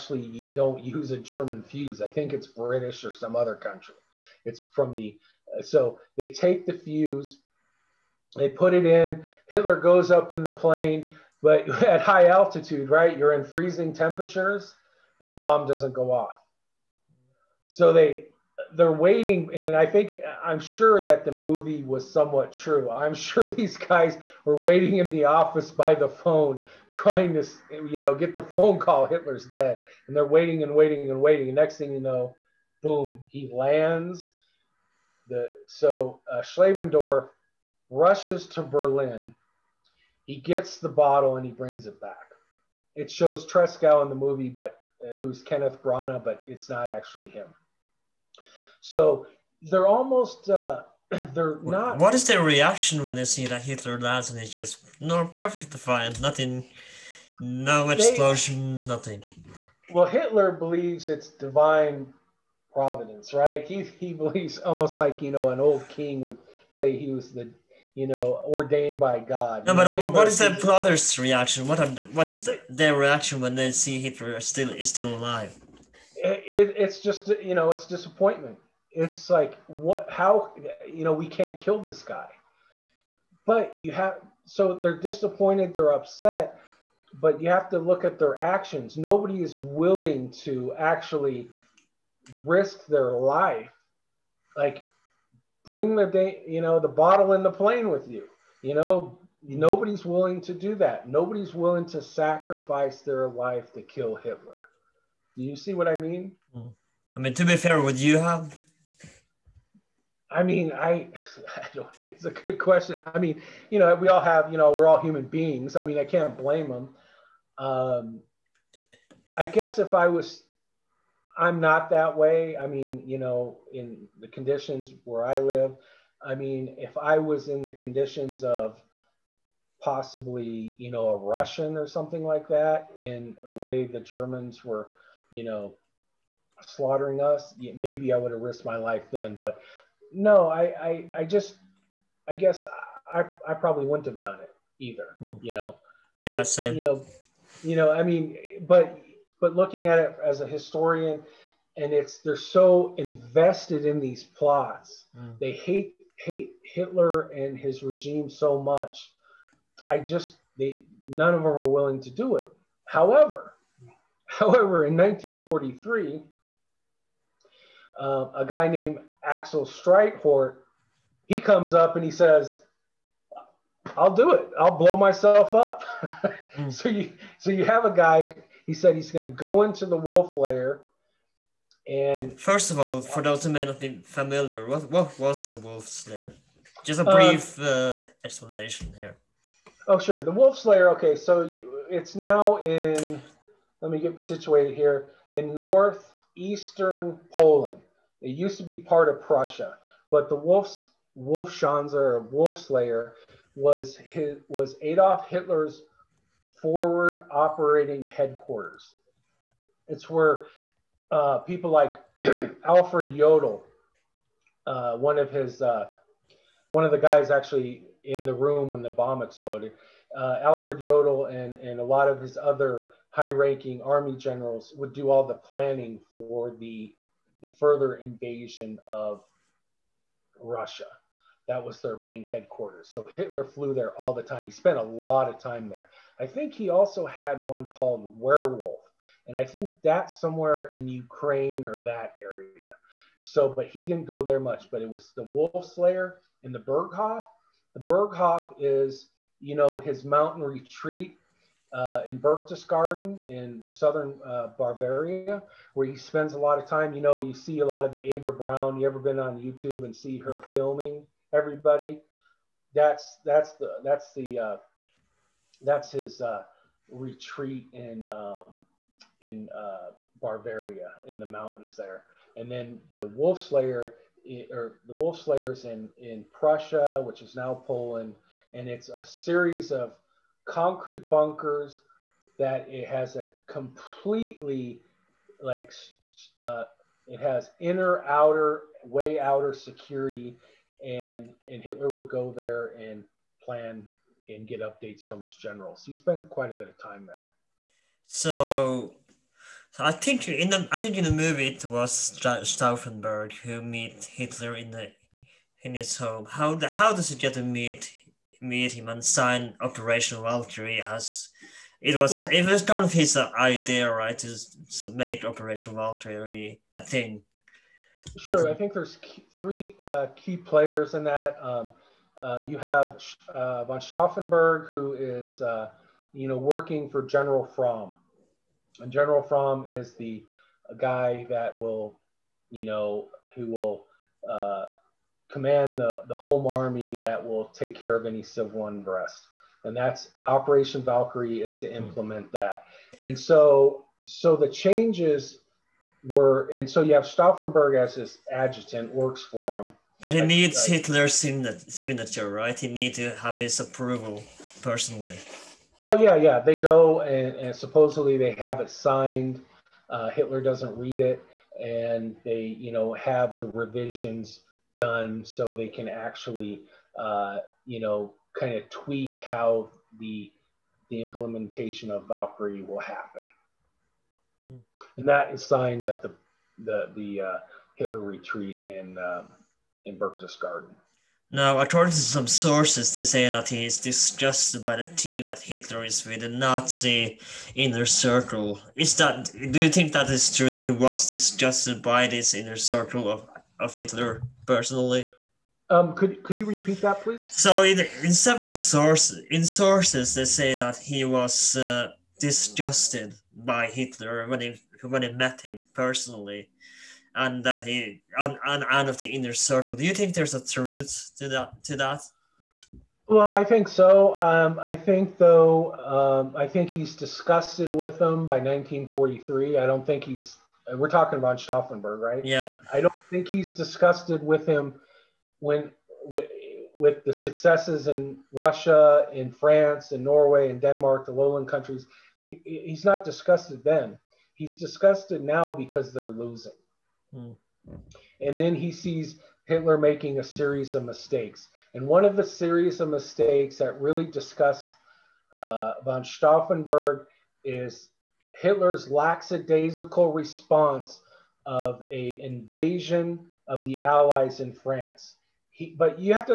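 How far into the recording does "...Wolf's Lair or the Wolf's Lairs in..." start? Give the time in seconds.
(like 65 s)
273 s.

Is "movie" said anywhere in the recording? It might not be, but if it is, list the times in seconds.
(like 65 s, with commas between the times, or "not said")
21 s, 44 s, 301 s.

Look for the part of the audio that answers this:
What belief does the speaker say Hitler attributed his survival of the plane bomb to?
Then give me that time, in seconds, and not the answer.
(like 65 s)
61 s.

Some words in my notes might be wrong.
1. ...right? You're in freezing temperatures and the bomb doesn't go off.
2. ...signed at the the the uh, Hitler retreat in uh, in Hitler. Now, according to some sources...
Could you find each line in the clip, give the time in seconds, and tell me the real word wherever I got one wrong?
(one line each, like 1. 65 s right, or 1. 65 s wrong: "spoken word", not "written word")
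1. 12 s right
2. 375 s wrong: "Berchtesgaden", not "Hitler".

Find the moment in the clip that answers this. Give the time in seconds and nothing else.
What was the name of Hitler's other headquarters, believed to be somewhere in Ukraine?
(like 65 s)
238 s.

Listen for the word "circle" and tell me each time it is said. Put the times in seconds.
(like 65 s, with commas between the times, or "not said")
387 s, 392 s, 409 s.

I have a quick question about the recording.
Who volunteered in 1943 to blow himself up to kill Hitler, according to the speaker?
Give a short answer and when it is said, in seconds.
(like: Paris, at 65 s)
Axel Strikehort, at 169 s.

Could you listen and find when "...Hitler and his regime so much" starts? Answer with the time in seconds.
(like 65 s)
156 s.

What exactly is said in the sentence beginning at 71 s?
What are the, what is the, their reaction when they see Hitler still is still alive?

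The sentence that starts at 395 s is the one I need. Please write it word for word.
Um, could could you repeat that, please?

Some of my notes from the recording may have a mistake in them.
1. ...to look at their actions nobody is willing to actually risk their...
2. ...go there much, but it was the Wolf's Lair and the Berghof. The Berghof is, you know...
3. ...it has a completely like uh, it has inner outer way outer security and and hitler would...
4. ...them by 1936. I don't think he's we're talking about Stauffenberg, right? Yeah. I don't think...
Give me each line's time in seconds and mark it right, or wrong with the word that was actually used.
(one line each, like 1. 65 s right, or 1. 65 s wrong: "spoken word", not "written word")
1. 87 s right
2. 244 s right
3. 282 s right
4. 417 s wrong: "1943", not "1936".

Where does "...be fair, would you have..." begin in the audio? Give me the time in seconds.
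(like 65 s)
107 s.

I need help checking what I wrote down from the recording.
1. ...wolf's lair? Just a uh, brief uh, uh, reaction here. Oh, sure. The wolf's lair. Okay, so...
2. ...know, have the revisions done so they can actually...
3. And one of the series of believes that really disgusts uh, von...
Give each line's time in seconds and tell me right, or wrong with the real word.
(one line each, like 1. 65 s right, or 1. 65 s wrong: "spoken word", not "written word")
1. 185 s wrong: "explanation", not "reaction"
2. 362 s right
3. 441 s wrong: "mistakes", not "believes".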